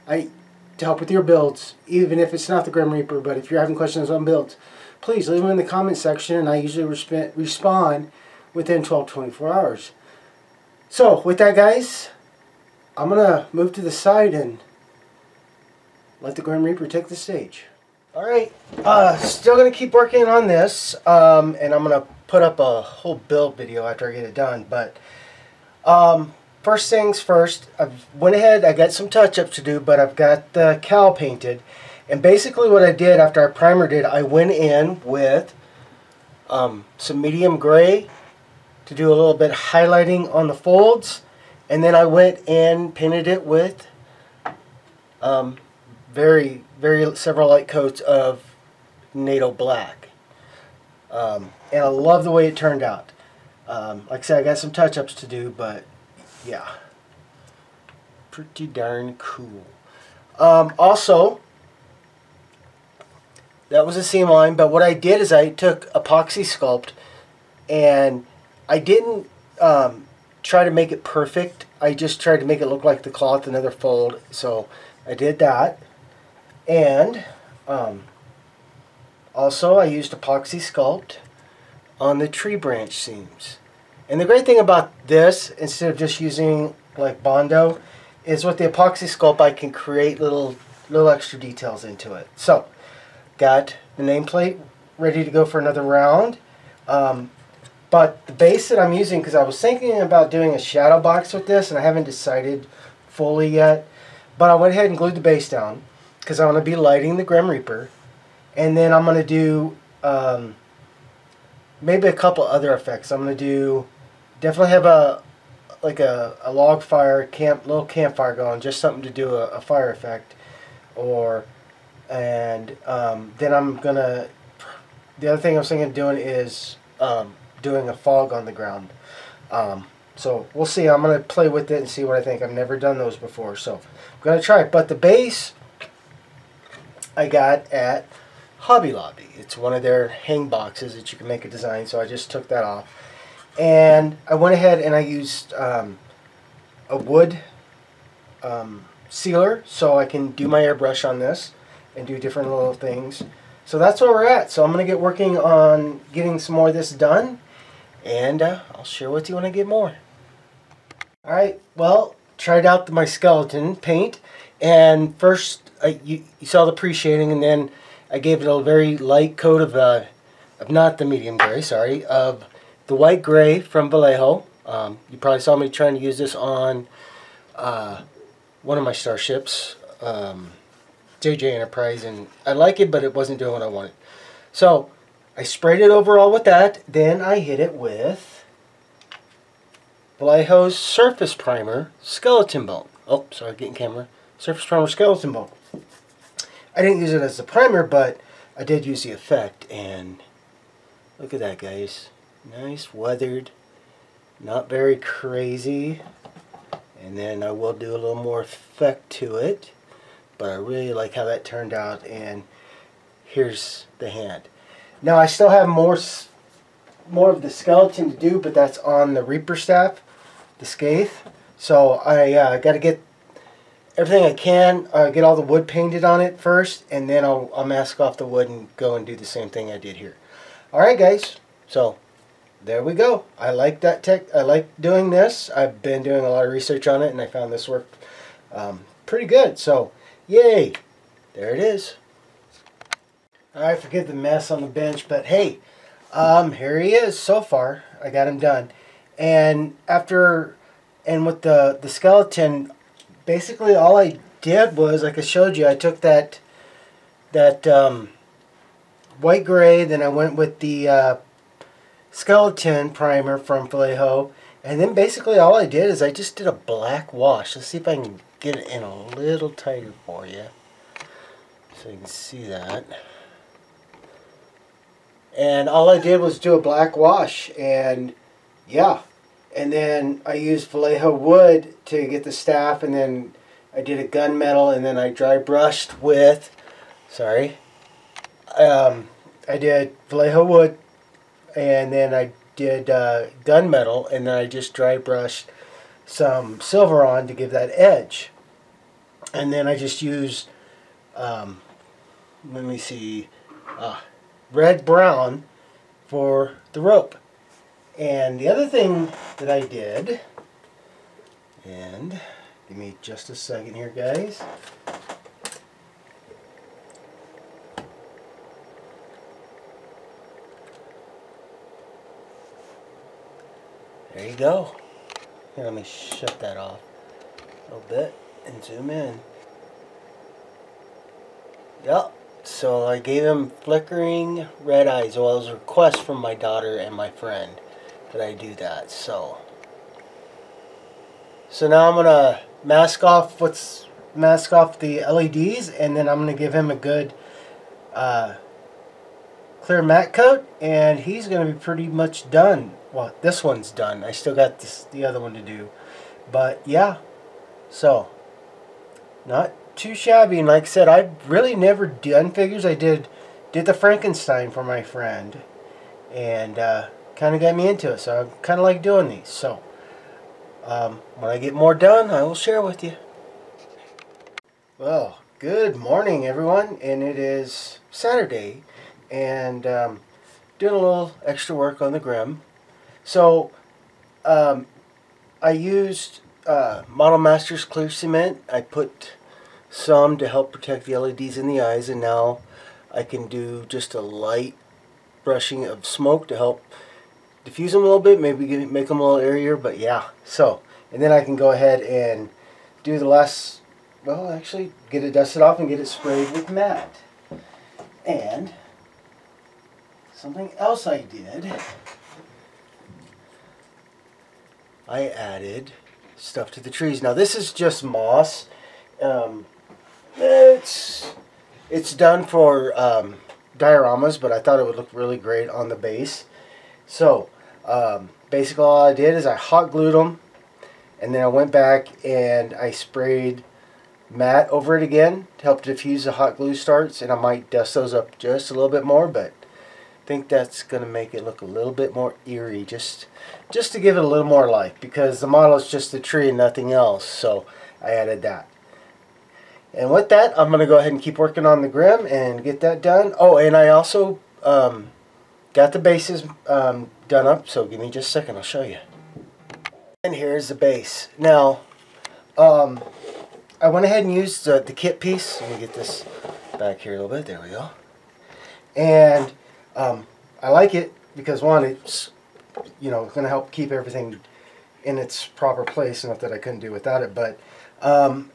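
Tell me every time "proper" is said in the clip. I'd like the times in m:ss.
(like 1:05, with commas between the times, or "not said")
7:55.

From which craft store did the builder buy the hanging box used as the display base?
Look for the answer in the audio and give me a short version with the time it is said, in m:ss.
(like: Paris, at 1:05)
Hobby Lobby, at 2:18.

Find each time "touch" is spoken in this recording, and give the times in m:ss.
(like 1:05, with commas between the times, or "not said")
0:29, 0:54.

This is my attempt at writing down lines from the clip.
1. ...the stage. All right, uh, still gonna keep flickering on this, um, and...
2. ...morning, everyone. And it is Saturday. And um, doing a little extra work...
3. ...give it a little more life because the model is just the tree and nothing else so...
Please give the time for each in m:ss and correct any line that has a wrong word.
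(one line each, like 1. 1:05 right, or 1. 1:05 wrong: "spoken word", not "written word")
1. 0:17 wrong: "working", not "flickering"
2. 6:15 right
3. 7:23 right.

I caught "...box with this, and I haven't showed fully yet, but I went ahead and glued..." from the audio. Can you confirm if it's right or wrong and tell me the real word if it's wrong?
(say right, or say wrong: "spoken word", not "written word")
wrong: "decided", not "showed".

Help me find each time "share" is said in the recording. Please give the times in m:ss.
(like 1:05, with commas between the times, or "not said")
2:38, 6:12.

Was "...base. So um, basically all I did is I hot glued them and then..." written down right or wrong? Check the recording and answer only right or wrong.
right.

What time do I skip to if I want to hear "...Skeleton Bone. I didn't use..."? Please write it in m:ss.
3:14.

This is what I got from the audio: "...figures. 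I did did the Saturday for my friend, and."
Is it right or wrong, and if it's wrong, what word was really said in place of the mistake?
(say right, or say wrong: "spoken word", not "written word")
wrong: "Frankenstein", not "Saturday".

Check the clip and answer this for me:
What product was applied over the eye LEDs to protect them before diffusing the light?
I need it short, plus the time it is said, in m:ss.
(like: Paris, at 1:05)
Model Masters clear cement, at 6:26.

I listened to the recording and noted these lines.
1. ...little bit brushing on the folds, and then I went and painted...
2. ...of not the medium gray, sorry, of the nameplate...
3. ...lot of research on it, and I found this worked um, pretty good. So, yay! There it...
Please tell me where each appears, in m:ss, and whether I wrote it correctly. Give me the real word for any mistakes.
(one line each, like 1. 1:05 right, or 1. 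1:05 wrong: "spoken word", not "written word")
1. 0:39 wrong: "highlighting", not "brushing"
2. 2:50 wrong: "white", not "nameplate"
3. 3:56 right.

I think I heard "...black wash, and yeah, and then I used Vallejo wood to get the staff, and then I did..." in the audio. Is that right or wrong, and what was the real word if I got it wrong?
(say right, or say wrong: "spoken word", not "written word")
right.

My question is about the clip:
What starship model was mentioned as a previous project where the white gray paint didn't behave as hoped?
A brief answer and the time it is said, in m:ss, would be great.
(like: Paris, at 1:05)
JJ Enterprise, at 3:01.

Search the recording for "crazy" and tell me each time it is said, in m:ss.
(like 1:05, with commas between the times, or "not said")
3:24.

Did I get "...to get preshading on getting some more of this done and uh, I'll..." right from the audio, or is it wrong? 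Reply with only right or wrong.
wrong.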